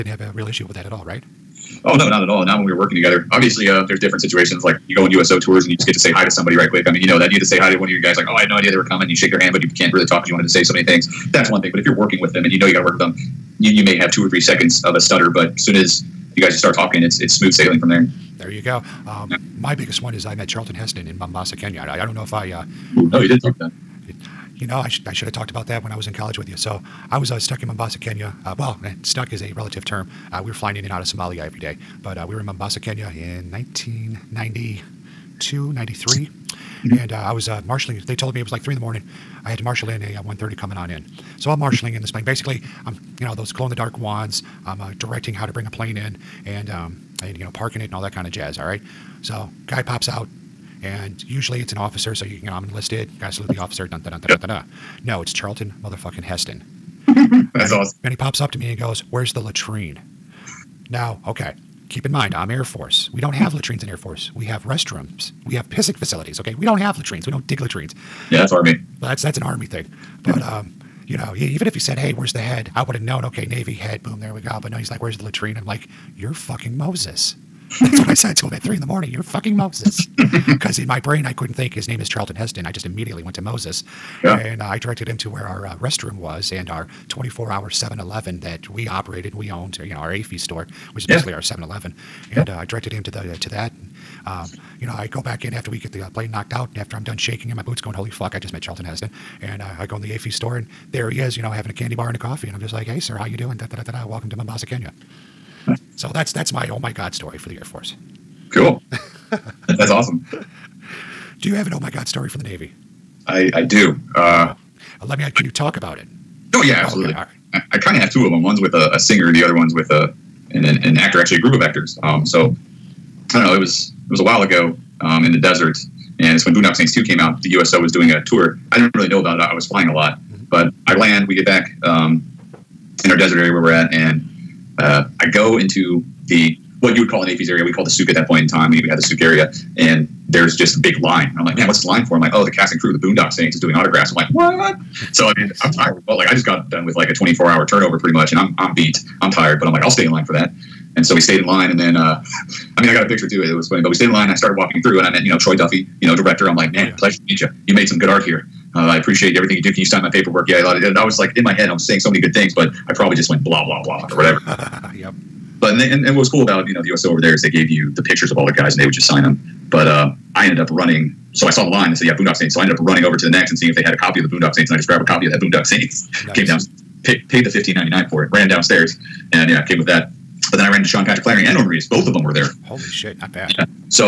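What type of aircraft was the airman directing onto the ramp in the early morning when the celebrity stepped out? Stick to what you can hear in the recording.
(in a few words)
130.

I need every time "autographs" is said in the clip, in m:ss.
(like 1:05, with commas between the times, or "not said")
2:23.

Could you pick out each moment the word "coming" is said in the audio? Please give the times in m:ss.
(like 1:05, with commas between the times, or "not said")
0:08, 0:40.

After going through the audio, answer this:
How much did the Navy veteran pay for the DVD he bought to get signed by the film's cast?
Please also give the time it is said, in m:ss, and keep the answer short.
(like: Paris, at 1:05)
$15.99, at 2:57.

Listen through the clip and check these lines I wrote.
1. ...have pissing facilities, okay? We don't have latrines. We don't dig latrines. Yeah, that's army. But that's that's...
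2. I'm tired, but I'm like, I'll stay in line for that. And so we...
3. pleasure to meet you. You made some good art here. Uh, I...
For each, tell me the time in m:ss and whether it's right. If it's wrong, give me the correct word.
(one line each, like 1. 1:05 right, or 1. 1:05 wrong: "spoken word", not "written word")
1. 1:05 right
2. 2:29 right
3. 2:36 right.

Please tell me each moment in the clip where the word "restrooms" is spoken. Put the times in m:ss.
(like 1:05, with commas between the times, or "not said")
1:04, 1:25.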